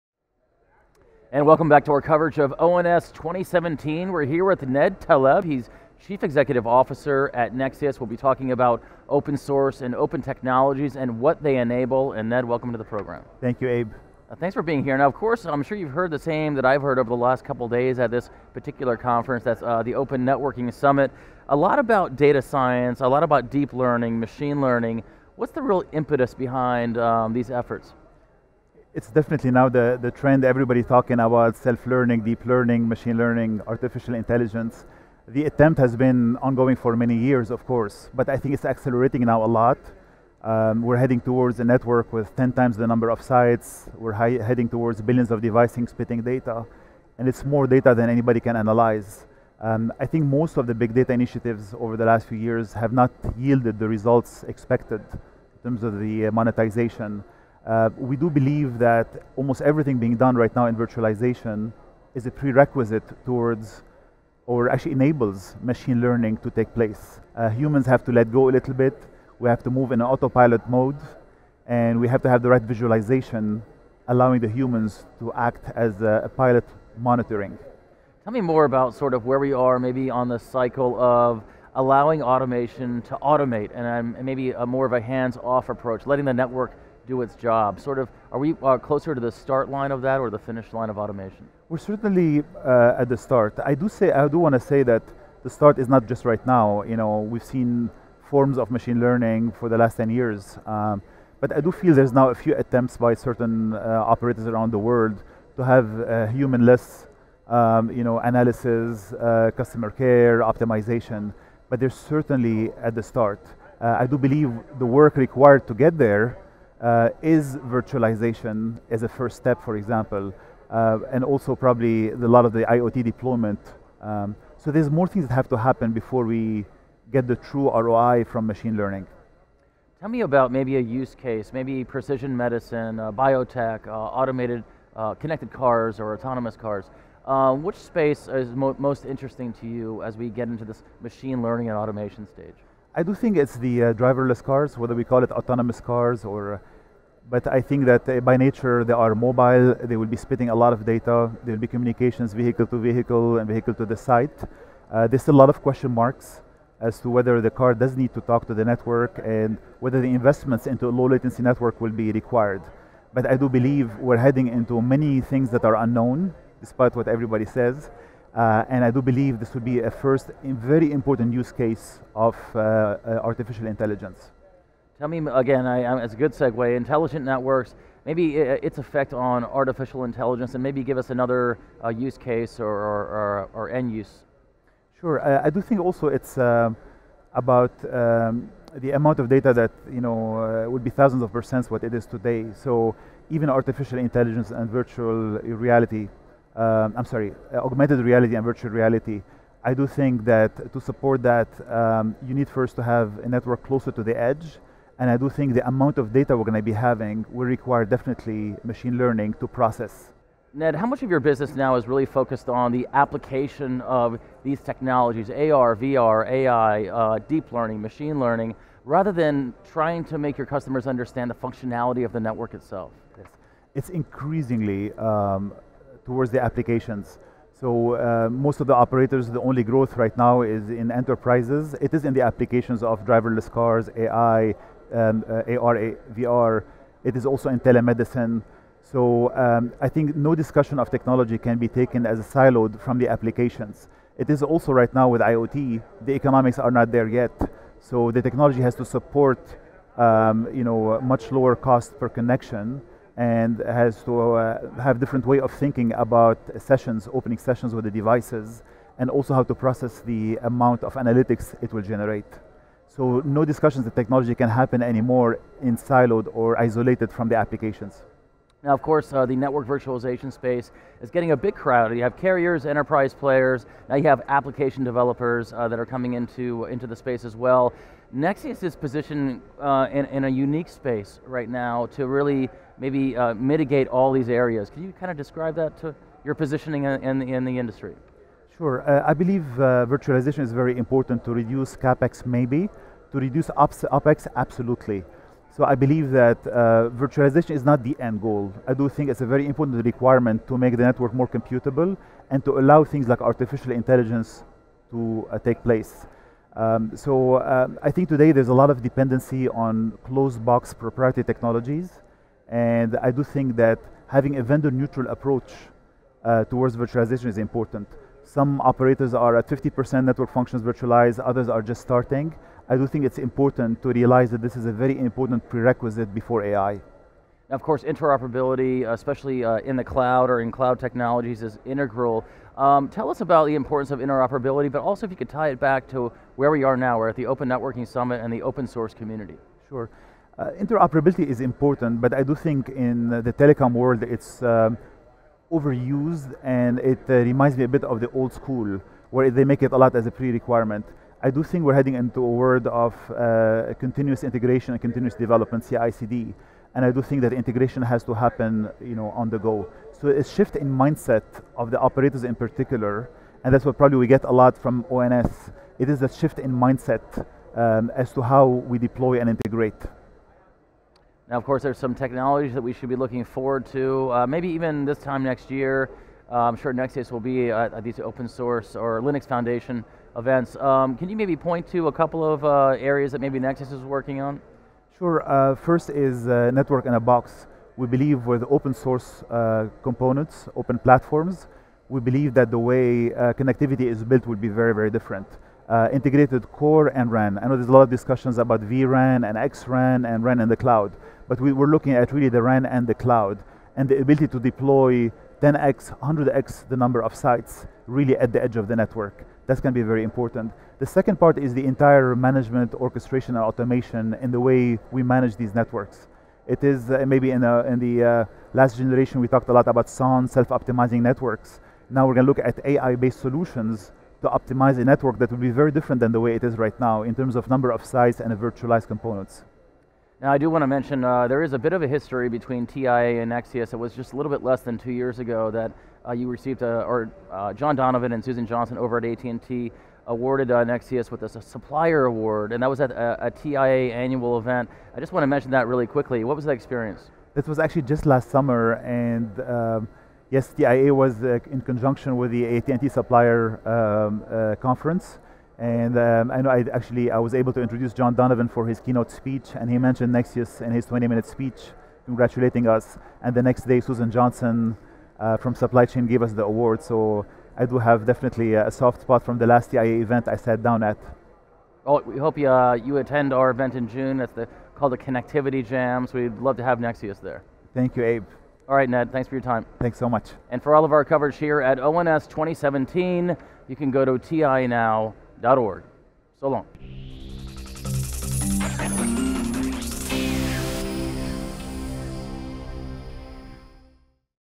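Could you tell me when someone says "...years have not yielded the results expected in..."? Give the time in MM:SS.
00:52.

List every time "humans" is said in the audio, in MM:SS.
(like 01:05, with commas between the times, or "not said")
01:07, 01:14, 01:46.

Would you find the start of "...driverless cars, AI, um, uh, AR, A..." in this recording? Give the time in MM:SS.
03:53.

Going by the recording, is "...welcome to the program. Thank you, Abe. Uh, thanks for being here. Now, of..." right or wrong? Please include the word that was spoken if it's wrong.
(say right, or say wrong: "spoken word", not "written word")
right.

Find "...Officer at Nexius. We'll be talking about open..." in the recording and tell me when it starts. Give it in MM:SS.
00:06.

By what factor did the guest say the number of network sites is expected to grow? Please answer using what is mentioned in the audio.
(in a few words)
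10 times.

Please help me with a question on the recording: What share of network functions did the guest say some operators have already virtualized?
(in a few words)
50%.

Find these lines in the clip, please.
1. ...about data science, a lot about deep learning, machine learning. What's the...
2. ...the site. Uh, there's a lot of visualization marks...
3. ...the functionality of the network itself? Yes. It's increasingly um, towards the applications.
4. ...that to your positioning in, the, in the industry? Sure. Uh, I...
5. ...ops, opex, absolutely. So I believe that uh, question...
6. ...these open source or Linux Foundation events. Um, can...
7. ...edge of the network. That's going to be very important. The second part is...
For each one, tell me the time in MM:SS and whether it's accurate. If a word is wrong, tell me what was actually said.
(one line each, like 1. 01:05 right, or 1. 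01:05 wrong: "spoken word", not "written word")
1. 00:21 right
2. 02:33 wrong: "question", not "visualization"
3. 03:41 right
4. 04:45 right
5. 04:53 wrong: "virtualization", not "question"
6. 06:17 right
7. 06:48 right.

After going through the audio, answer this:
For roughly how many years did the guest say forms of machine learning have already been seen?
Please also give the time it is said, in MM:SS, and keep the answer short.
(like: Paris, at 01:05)
10 years, at 01:39.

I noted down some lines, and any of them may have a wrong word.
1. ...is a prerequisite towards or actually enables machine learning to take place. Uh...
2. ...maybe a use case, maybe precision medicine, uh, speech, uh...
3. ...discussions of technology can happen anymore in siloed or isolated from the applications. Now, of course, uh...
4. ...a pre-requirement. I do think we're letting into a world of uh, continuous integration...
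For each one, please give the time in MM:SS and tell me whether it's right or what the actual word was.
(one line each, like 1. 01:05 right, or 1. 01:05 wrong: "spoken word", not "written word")
1. 01:02 right
2. 02:10 wrong: "biotech", not "speech"
3. 04:23 right
4. 05:50 wrong: "heading", not "letting".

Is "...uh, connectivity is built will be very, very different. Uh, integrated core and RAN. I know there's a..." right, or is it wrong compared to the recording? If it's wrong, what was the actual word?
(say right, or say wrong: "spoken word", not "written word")
right.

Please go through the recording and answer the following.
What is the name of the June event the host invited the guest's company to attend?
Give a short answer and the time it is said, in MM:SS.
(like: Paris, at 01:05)
Connectivity Jam, at 07:54.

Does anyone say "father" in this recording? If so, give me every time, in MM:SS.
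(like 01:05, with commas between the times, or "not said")
not said.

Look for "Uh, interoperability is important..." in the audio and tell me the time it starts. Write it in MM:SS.
05:40.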